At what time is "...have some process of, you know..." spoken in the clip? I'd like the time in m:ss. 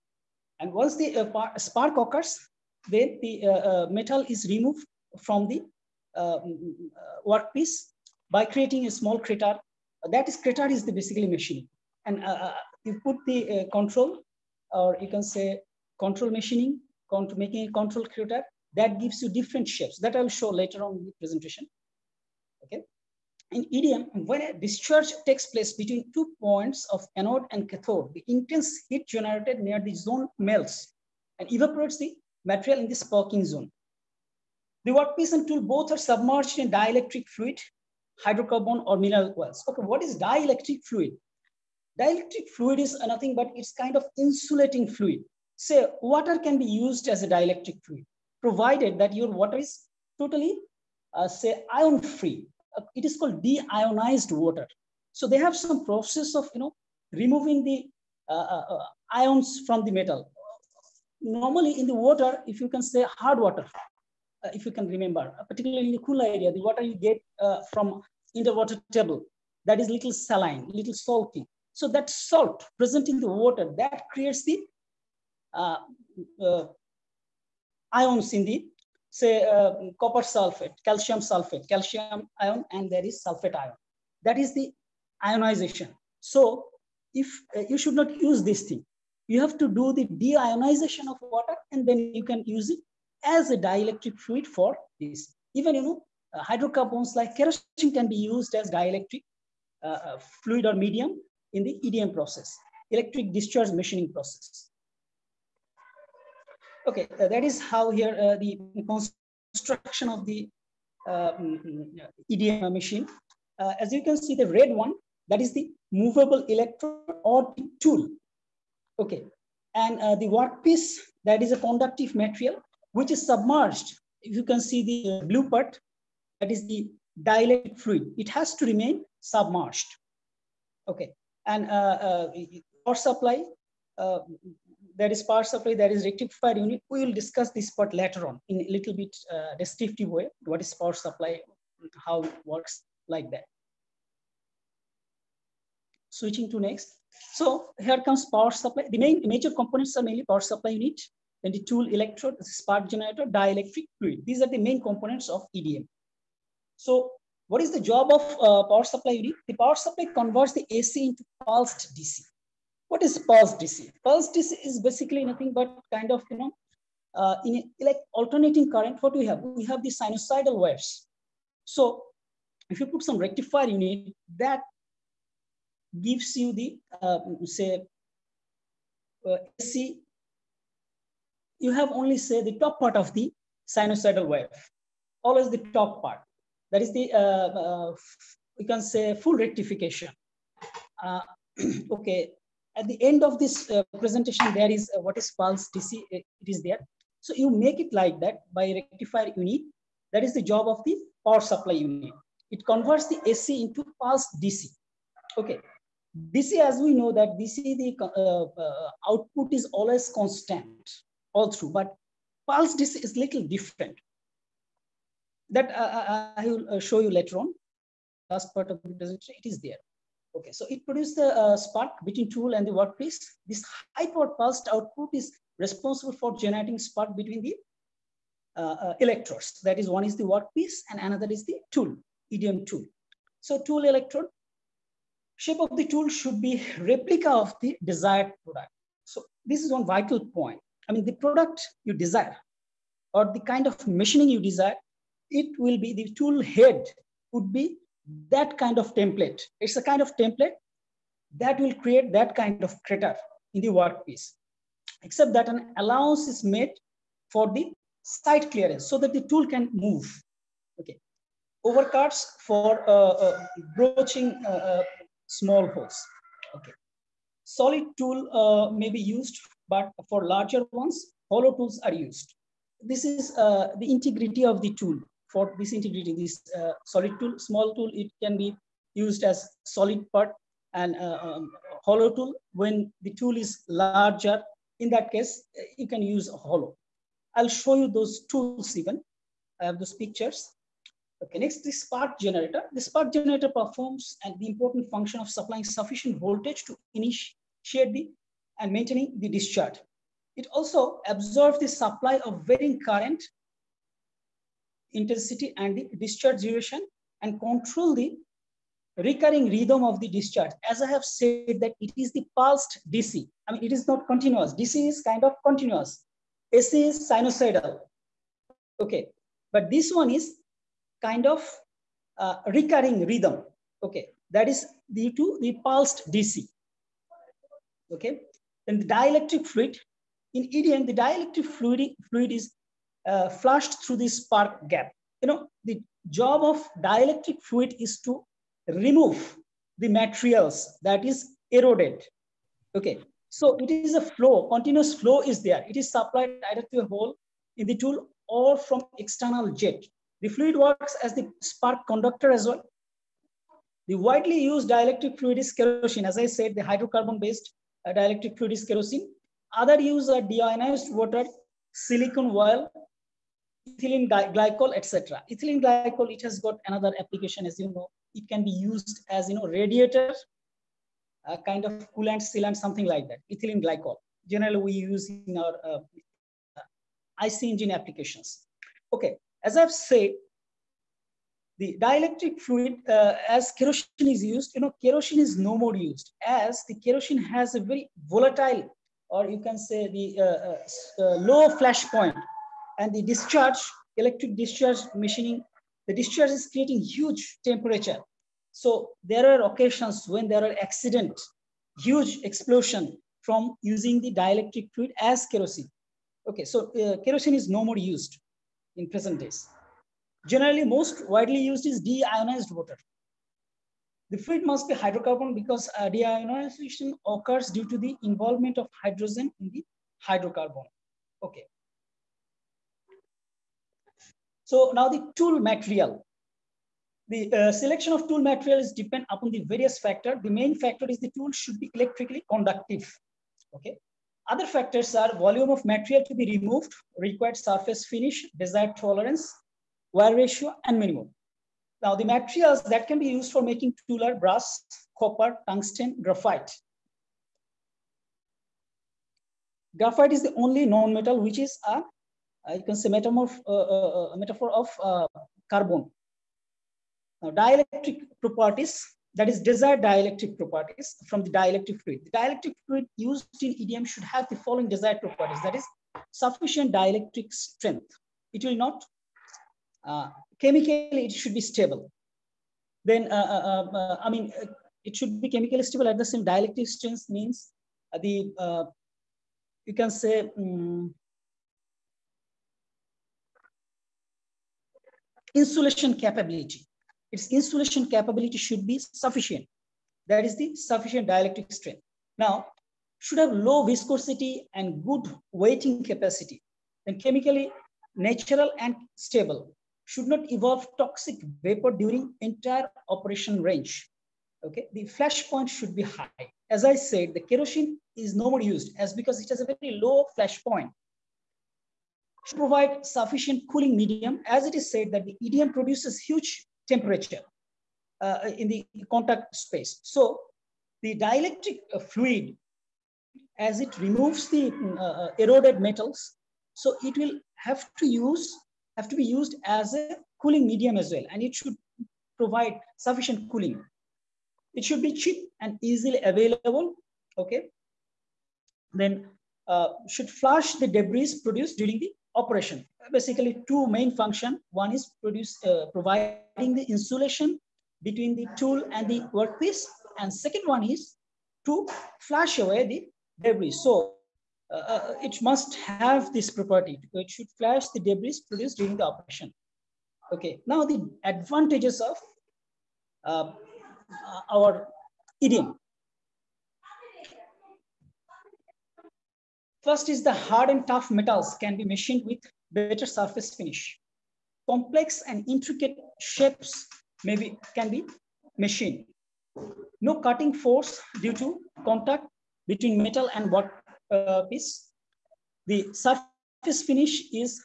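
0:55.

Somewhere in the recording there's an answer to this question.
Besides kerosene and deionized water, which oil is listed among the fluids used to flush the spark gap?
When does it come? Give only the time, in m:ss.
6:01.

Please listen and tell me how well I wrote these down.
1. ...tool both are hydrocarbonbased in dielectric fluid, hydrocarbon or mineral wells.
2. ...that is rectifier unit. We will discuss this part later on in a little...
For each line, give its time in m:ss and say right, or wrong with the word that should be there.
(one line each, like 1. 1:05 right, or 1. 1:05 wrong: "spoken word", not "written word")
1. 0:35 wrong: "submerged", not "hydrocarbonbased"
2. 2:15 right.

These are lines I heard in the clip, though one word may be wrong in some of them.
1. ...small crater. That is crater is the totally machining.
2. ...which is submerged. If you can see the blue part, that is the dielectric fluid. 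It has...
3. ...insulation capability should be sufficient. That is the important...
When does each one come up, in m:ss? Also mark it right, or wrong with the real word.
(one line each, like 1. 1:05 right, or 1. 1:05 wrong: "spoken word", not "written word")
1. 0:08 wrong: "basically", not "totally"
2. 2:02 right
3. 8:07 wrong: "sufficient", not "important".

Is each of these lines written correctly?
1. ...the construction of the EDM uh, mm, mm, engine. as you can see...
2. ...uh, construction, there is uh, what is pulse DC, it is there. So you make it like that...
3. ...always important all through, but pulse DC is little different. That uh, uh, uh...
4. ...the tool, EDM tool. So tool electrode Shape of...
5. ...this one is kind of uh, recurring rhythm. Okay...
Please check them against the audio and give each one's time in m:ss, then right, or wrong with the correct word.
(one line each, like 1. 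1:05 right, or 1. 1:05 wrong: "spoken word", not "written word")
1. 1:48 wrong: "machine", not "engine"
2. 3:13 wrong: "presentation", not "construction"
3. 3:29 wrong: "constant", not "important"
4. 3:51 right
5. 5:19 right.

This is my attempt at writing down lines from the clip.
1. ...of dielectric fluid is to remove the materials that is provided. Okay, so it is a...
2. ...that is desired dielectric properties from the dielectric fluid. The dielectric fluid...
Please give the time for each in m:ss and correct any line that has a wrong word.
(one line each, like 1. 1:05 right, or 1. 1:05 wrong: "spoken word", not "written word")
1. 5:36 wrong: "eroded", not "provided"
2. 7:39 right.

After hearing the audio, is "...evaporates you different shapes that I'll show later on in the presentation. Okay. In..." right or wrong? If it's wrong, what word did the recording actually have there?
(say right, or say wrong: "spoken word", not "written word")
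wrong: "gives", not "evaporates".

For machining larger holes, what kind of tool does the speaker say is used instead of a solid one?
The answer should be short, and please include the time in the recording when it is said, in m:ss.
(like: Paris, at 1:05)
hollow tools, at 4:31.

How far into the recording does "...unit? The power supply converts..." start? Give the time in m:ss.
2:39.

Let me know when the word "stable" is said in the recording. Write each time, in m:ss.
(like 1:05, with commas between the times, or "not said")
7:51, 7:55, 8:18.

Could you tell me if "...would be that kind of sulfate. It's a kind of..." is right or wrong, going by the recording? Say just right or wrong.
wrong.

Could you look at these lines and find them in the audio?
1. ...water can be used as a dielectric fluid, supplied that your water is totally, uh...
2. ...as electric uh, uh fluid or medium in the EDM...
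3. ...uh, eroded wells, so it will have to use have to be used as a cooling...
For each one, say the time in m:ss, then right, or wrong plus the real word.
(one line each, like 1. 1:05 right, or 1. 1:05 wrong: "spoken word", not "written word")
1. 0:46 wrong: "provided", not "supplied"
2. 1:38 wrong: "dielectric", not "electric"
3. 8:44 wrong: "metals", not "wells".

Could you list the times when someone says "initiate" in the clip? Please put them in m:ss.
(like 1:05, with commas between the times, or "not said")
4:56.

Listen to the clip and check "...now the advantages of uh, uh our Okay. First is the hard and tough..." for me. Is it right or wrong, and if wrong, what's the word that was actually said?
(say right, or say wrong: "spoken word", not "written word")
wrong: "EDM", not "Okay".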